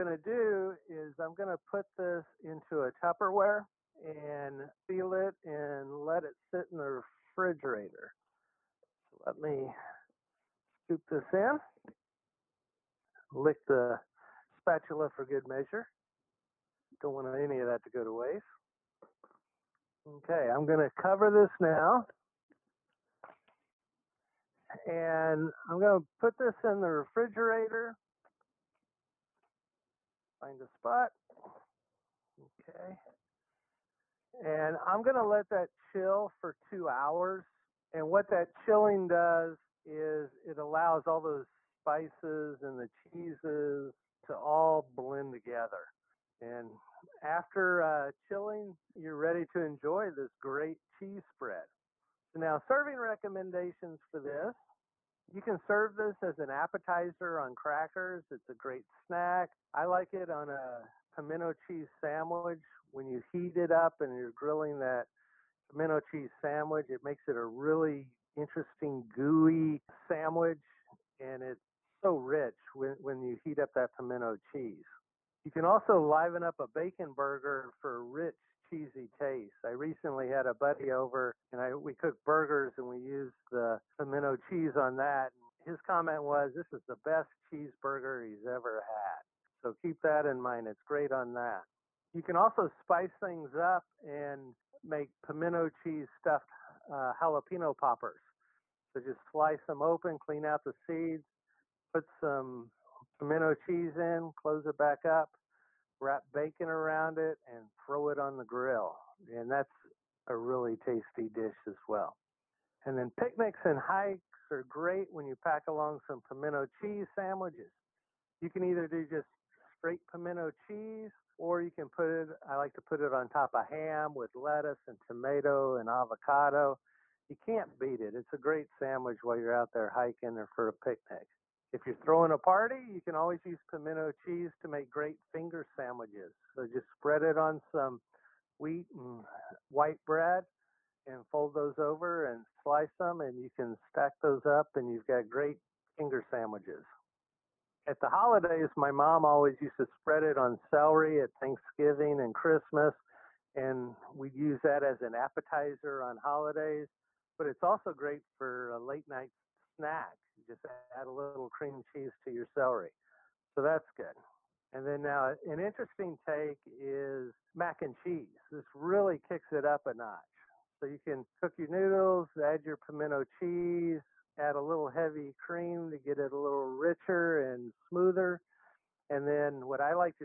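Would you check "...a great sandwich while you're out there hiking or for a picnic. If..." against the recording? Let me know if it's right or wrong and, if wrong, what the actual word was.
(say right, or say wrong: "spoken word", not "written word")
right.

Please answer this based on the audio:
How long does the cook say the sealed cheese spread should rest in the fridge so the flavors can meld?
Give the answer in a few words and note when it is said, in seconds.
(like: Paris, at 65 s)
2 hours, at 36 s.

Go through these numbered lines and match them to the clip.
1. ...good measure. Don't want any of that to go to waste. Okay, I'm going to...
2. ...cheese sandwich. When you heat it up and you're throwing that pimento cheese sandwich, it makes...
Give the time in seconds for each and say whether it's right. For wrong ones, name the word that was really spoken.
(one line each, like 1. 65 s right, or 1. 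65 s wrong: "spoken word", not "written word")
1. 15 s right
2. 61 s wrong: "grilling", not "throwing".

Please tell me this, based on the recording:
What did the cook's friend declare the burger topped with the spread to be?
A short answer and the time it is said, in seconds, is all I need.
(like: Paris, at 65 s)
The best cheeseburger, at 87 s.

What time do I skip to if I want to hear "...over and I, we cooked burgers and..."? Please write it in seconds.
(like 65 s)
80 s.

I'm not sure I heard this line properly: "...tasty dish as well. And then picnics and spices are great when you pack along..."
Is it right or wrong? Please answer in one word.
wrong.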